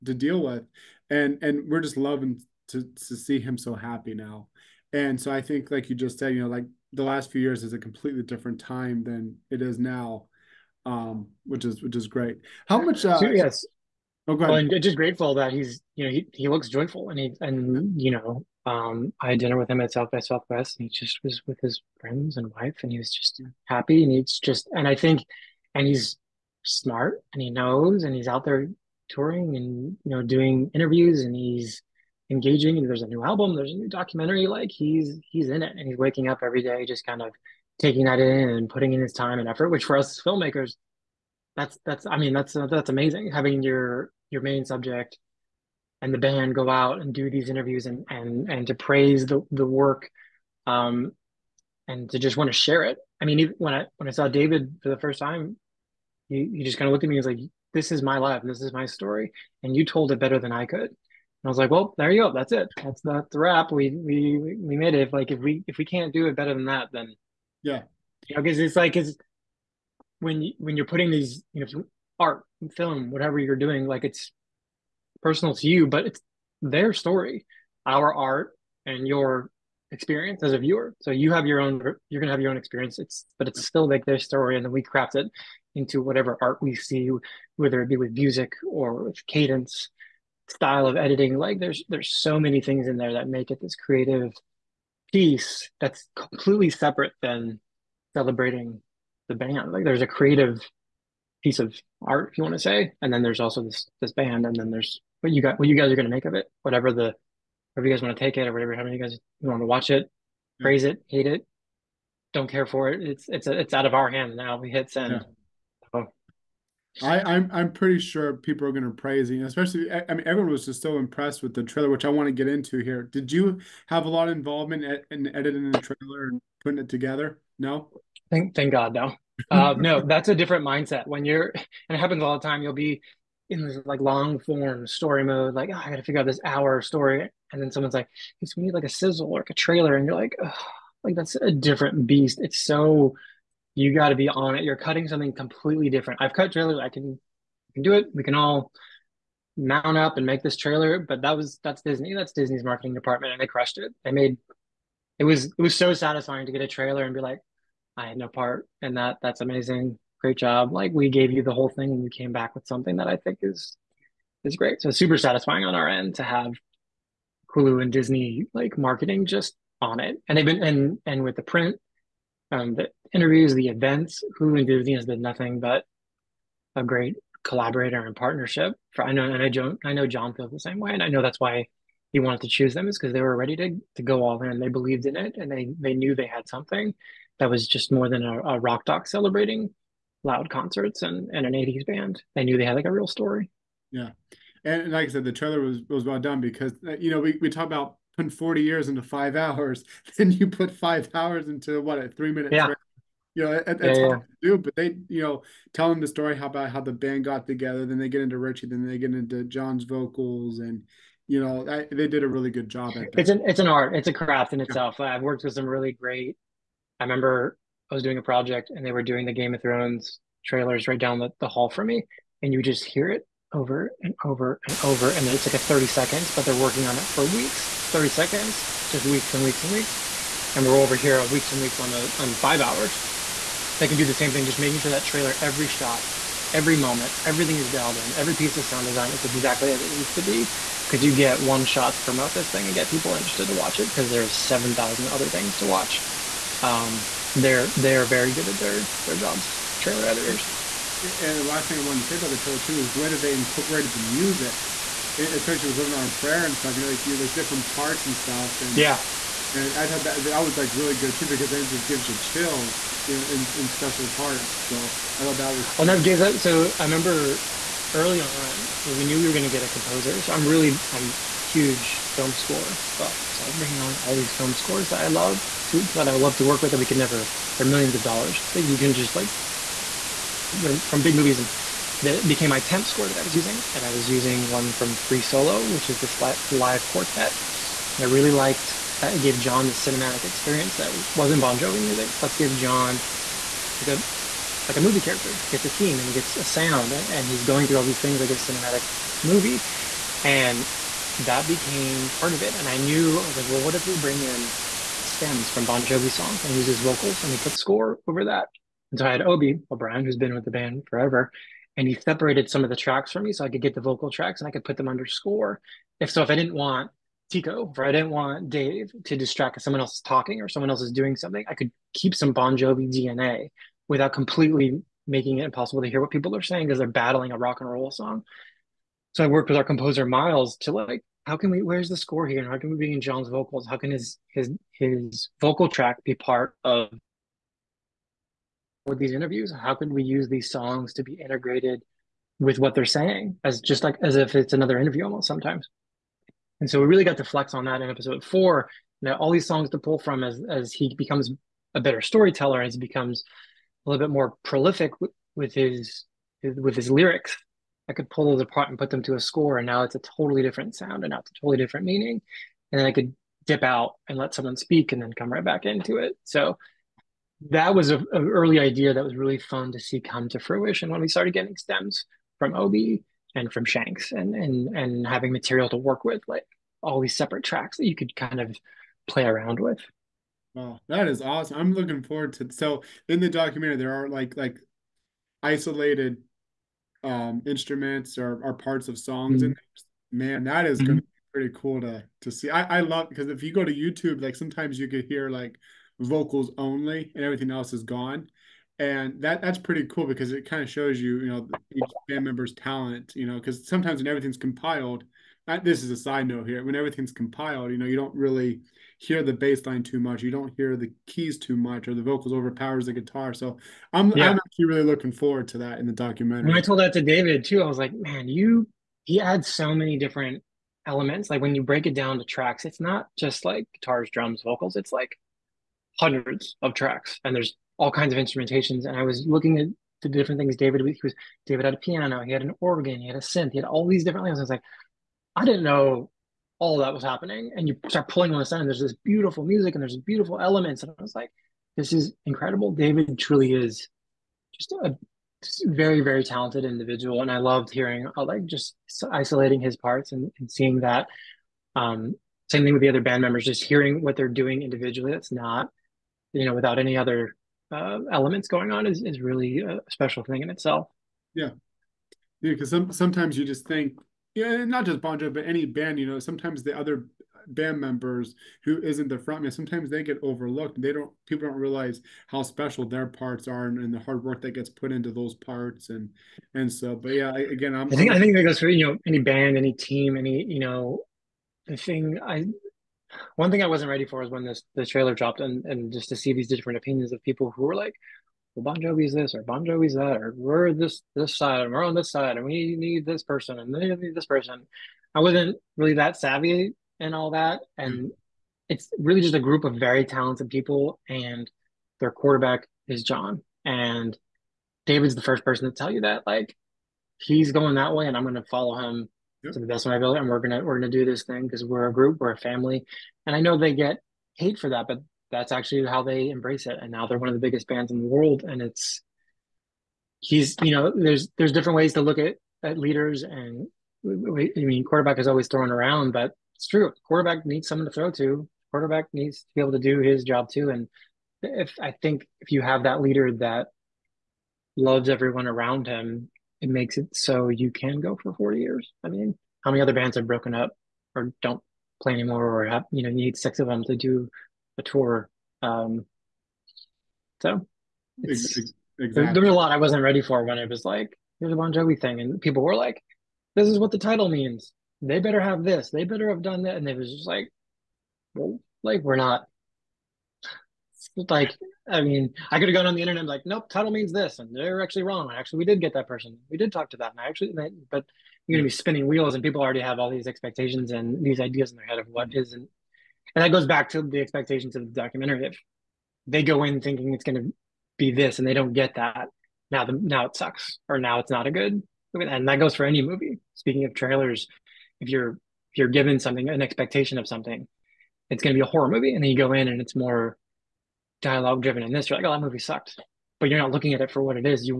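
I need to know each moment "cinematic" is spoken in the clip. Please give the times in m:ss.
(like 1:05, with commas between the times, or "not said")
4:49, 4:58.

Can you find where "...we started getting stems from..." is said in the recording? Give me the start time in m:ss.
6:11.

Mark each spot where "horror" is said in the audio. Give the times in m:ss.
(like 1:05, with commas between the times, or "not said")
9:48.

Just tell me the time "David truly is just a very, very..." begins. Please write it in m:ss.
7:22.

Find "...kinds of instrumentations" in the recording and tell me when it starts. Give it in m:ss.
7:07.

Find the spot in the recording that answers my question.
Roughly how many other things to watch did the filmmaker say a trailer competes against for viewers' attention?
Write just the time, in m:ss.
4:04.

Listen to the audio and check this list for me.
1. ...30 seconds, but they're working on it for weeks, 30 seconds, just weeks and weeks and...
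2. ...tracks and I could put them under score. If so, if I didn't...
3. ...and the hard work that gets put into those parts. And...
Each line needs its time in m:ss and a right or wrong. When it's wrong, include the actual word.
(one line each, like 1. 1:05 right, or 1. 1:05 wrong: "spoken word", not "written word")
1. 3:45 right
2. 5:14 right
3. 7:53 right.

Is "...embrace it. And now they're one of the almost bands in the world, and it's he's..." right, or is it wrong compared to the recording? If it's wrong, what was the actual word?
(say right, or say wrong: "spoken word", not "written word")
wrong: "biggest", not "almost".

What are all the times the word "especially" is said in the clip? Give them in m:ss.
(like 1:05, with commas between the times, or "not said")
1:59, 4:15.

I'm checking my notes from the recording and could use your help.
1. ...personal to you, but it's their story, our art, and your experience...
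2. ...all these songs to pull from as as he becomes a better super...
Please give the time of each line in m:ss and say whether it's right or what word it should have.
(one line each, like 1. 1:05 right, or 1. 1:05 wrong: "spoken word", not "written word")
1. 1:15 right
2. 5:49 wrong: "storyteller", not "super".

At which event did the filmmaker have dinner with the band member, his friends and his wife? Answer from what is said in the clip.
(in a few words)
South by Southwest.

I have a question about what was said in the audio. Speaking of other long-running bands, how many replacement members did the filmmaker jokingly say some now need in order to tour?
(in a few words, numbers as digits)
6.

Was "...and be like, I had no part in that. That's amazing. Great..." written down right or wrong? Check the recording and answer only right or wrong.
right.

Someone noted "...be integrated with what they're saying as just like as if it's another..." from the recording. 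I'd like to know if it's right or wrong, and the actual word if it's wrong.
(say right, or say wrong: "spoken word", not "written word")
right.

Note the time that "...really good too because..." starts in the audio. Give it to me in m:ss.
4:20.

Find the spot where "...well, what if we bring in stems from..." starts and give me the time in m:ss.
5:03.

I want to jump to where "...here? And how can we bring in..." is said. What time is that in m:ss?
5:32.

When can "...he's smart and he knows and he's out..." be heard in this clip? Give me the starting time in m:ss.
0:25.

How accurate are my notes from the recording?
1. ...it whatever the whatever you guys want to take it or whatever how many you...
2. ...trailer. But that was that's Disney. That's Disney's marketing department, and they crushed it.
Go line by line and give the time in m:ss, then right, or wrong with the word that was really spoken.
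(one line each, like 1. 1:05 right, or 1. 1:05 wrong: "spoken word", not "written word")
1. 1:46 right
2. 2:30 right.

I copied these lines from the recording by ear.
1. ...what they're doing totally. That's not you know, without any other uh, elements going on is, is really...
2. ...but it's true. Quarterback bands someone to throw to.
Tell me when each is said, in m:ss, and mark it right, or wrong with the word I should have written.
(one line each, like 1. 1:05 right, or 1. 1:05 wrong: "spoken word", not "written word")
1. 7:34 wrong: "individually", not "totally"
2. 8:46 wrong: "needs", not "bands".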